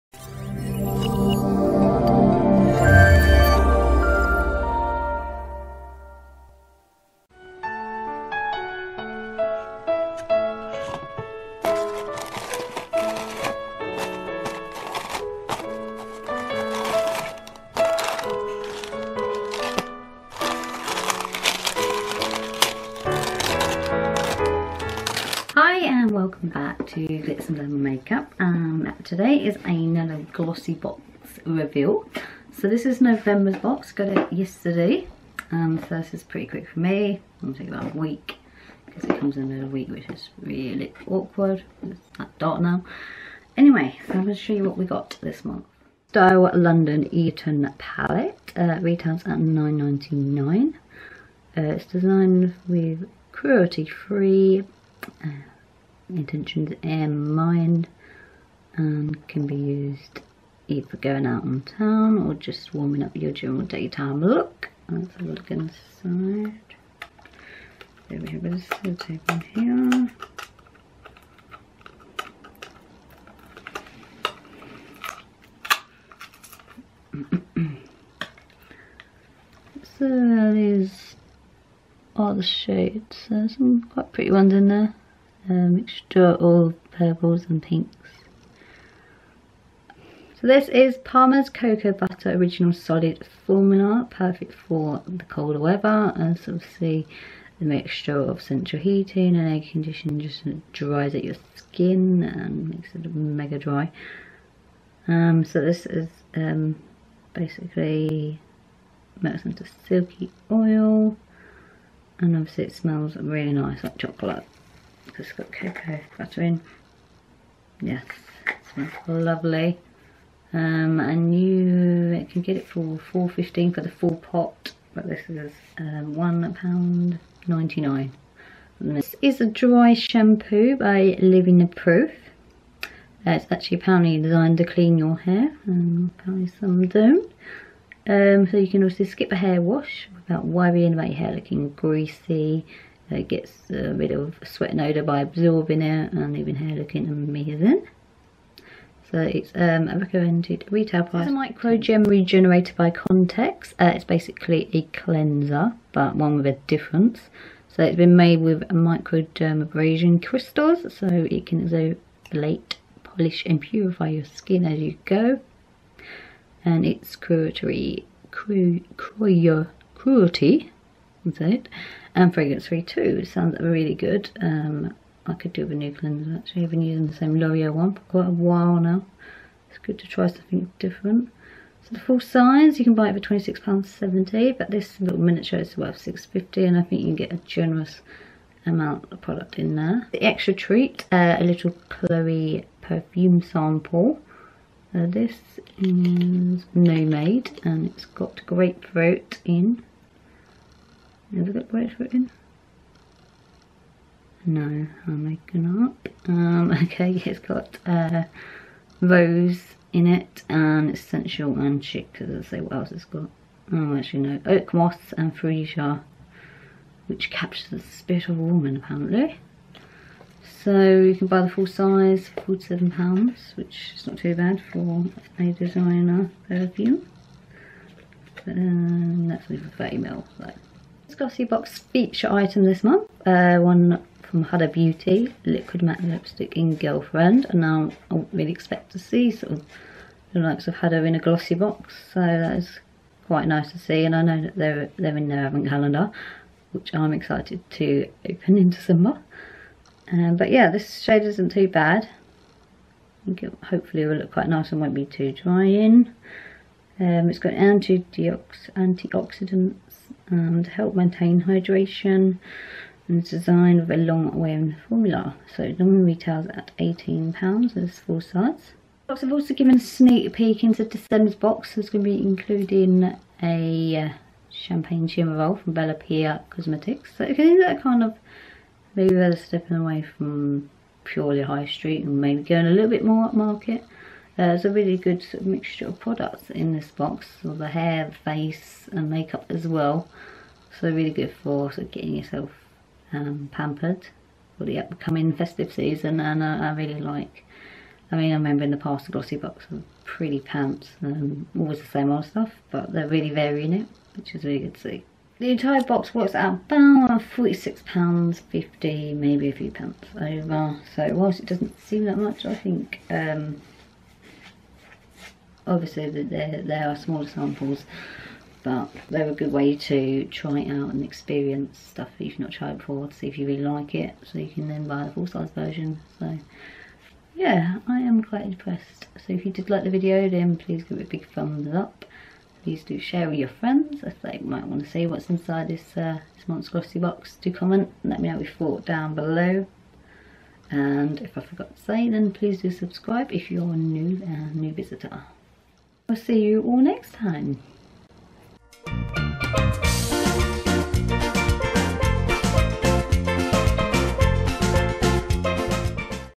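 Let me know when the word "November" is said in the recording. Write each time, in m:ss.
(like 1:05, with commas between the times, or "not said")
0:32.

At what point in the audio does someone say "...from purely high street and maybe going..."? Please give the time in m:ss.
4:40.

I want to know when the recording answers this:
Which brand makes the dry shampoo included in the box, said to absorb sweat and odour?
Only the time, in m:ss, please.
2:11.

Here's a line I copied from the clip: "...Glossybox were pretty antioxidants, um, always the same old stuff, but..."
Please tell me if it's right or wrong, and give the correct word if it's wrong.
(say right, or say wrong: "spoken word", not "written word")
wrong: "pants", not "antioxidants".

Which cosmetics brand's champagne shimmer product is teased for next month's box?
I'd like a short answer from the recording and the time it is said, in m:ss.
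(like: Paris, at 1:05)
Bellápierre Cosmetics, at 4:35.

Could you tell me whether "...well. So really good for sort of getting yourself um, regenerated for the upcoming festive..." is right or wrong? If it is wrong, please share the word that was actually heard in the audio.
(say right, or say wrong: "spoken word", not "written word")
wrong: "pampered", not "regenerated".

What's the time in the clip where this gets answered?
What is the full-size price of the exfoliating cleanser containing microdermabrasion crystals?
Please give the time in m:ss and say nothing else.
3:03.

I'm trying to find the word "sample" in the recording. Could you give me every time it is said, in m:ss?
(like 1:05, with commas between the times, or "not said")
3:13, 5:17.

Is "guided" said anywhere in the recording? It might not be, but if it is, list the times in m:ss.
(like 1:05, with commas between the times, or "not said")
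not said.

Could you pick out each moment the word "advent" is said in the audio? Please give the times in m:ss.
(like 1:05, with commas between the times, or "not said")
4:05.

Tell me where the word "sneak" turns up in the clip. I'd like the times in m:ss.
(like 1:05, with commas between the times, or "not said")
4:29.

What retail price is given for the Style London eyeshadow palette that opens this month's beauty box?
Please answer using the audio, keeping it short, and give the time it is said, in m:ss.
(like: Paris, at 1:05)
£9.99, at 0:49.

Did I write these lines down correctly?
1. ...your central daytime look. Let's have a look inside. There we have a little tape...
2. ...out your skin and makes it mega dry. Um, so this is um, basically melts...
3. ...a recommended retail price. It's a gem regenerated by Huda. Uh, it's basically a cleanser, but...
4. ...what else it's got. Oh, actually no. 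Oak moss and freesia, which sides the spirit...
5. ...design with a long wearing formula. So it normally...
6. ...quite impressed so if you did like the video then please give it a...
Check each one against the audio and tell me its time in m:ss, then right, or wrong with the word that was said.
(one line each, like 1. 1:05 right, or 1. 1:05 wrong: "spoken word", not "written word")
1. 1:03 wrong: "general", not "central"
2. 1:41 right
3. 2:29 wrong: "Contex", not "Huda"
4. 3:32 wrong: "captures", not "sides"
5. 4:23 right
6. 5:28 right.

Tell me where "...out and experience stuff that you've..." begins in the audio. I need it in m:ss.
5:20.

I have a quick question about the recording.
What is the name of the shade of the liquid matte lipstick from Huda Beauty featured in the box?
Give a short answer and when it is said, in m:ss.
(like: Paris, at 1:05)
Girlfriend, at 3:56.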